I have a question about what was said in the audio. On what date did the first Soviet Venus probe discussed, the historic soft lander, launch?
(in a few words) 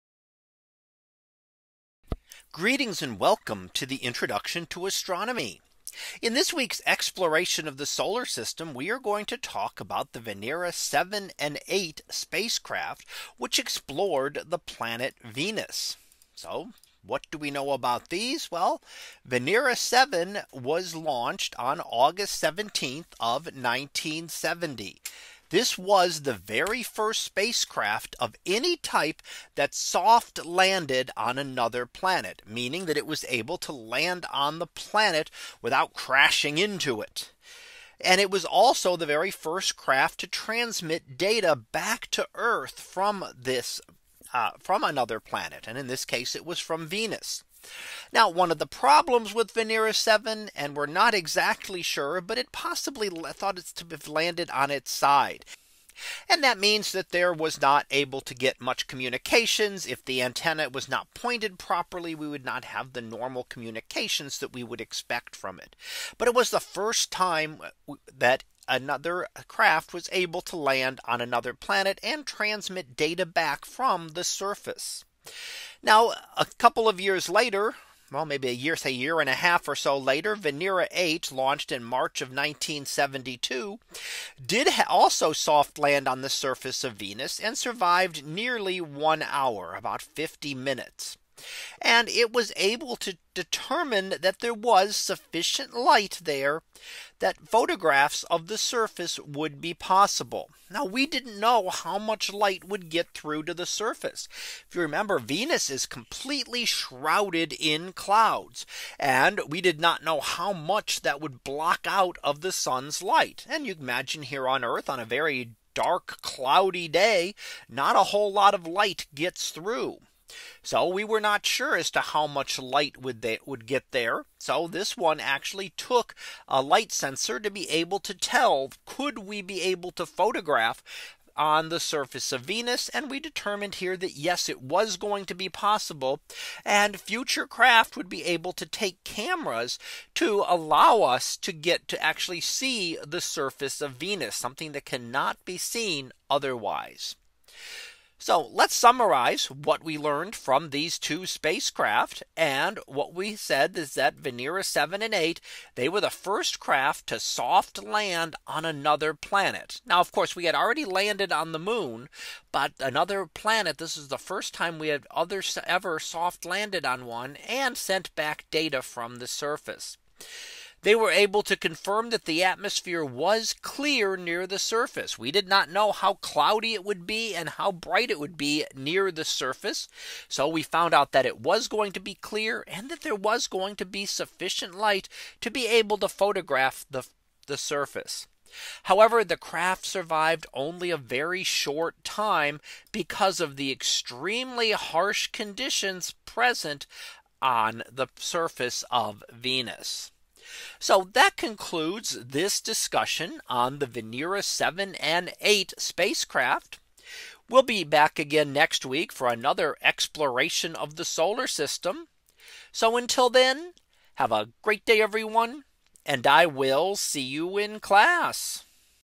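August 17th.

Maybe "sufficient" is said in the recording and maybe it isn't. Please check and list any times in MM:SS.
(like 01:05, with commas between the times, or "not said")
01:34, 03:04.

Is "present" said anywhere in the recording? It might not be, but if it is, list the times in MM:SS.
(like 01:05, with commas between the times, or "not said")
03:16.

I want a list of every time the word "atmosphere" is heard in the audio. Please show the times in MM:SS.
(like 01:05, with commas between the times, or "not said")
02:52.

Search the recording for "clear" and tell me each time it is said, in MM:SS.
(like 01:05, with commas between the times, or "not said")
02:53, 03:02.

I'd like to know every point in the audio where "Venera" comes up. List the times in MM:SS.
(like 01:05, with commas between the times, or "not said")
00:10, 00:19, 00:49, 01:20, 02:34, 03:23.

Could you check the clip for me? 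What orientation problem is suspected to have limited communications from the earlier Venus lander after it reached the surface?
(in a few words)
landed on its side.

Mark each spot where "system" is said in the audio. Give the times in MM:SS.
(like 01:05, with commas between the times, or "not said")
00:08, 03:31.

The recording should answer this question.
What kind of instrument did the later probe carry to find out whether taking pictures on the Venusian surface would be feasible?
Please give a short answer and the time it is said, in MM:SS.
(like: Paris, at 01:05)
light sensor, at 02:06.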